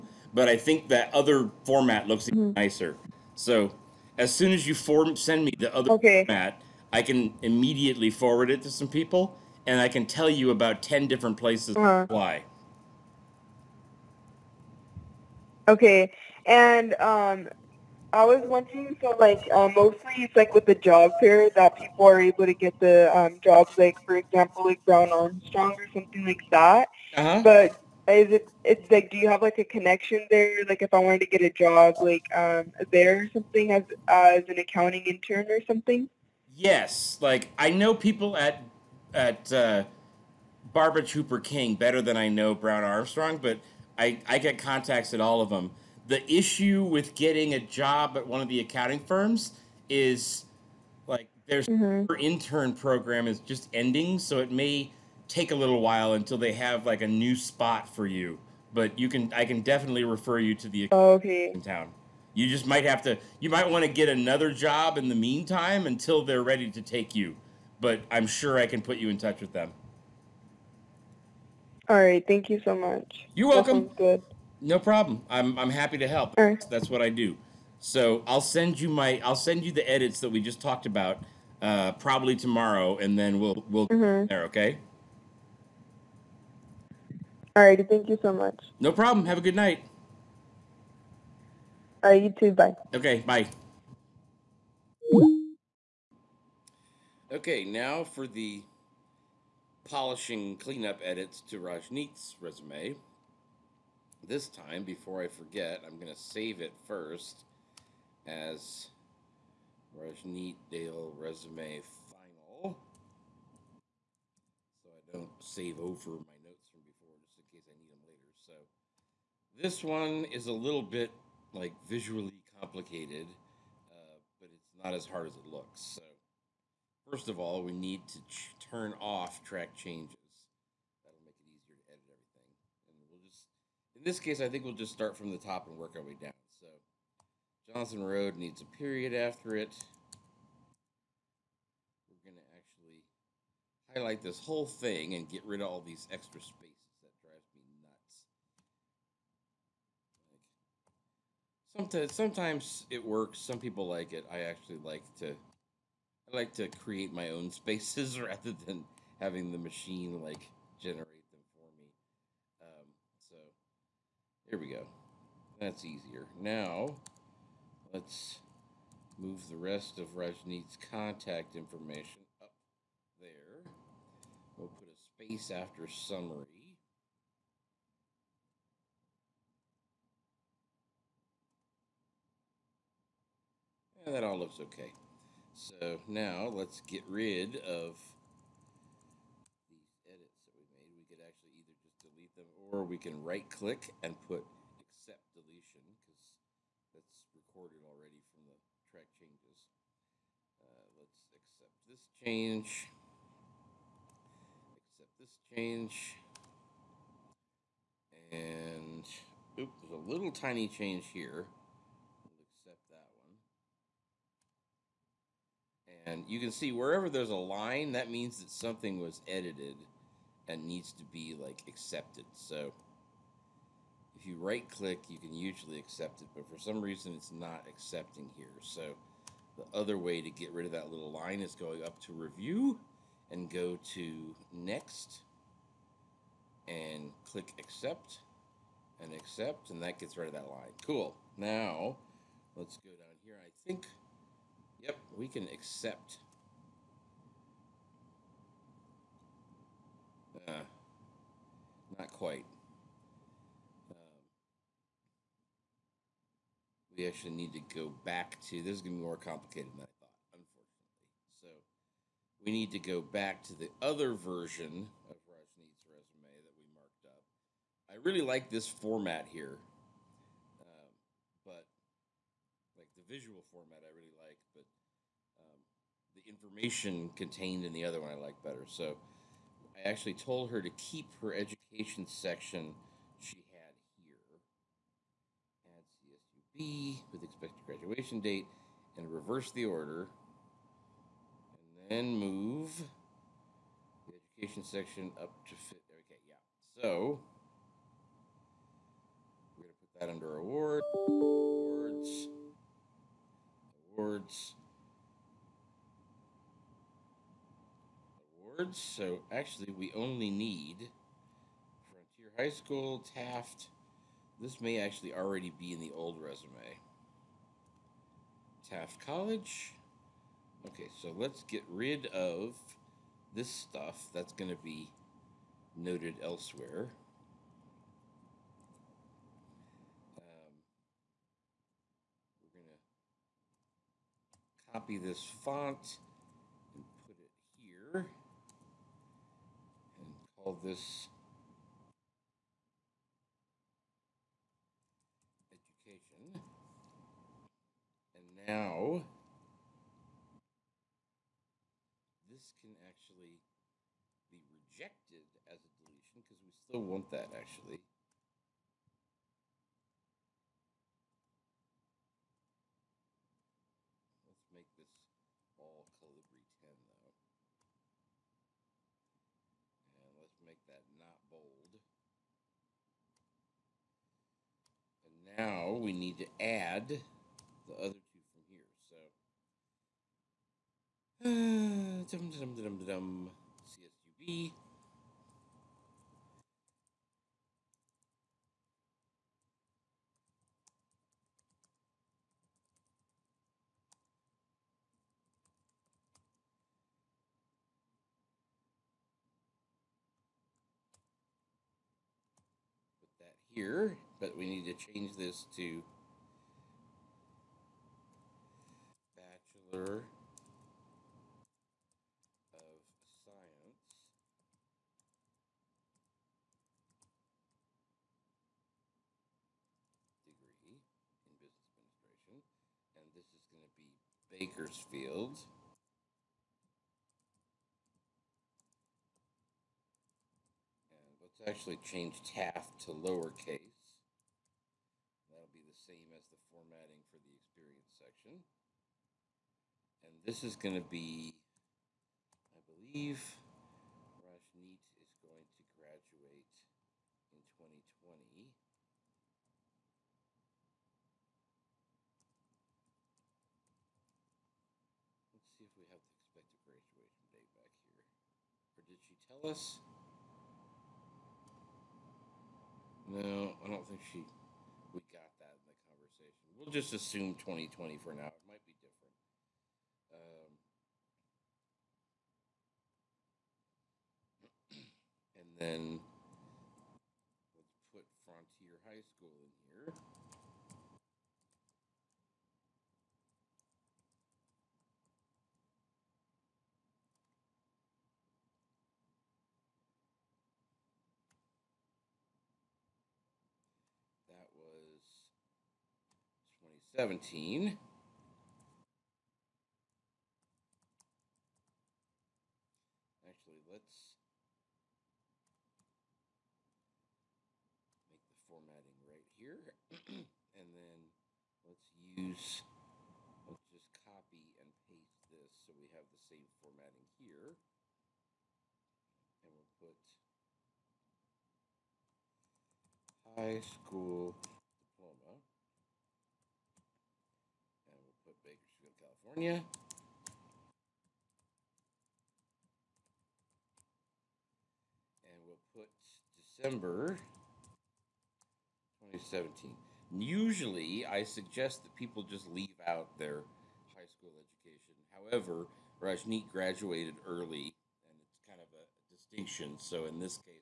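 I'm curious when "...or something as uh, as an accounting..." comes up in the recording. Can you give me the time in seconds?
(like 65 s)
33 s.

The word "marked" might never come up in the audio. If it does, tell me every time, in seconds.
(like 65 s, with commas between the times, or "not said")
266 s.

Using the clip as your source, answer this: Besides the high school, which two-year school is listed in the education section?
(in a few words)
Taft College.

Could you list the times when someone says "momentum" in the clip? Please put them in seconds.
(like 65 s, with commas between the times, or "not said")
not said.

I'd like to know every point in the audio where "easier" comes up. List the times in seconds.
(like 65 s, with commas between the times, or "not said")
165 s.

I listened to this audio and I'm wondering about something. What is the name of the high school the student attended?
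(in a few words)
Frontier High School.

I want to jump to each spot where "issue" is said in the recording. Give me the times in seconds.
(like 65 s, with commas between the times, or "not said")
46 s.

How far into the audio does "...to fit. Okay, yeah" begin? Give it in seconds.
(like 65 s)
295 s.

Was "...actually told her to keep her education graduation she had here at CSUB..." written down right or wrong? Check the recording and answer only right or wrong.
wrong.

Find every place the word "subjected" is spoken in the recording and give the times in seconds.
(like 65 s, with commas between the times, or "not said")
not said.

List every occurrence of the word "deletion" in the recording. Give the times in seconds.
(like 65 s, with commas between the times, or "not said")
195 s, 355 s.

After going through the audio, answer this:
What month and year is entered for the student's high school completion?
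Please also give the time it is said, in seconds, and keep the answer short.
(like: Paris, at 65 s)
December 2017, at 536 s.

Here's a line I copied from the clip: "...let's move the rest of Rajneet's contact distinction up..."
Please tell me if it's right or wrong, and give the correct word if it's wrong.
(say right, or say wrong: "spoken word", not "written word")
wrong: "information", not "distinction".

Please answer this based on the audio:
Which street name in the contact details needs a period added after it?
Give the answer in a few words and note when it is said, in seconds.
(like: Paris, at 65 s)
Johnson Road, at 137 s.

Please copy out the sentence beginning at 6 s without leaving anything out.
format, I can immediately forward it to some people, and I can tell you about ten different places uh -huh.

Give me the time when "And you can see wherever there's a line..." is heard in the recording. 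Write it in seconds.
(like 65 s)
216 s.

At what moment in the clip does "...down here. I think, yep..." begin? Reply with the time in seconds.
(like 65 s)
242 s.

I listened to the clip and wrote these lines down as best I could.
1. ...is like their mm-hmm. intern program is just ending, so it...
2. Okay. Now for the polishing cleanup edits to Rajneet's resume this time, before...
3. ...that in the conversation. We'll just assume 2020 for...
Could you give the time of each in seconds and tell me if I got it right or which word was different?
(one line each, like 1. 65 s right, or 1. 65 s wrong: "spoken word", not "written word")
1. 49 s right
2. 97 s right
3. 465 s right.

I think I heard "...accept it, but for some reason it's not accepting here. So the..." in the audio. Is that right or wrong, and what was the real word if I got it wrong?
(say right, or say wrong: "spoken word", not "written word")
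right.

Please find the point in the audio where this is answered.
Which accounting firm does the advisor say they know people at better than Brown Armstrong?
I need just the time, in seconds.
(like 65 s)
40 s.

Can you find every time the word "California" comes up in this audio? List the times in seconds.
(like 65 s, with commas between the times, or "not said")
529 s.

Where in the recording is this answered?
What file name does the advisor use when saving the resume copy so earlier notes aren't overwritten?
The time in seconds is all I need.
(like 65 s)
109 s.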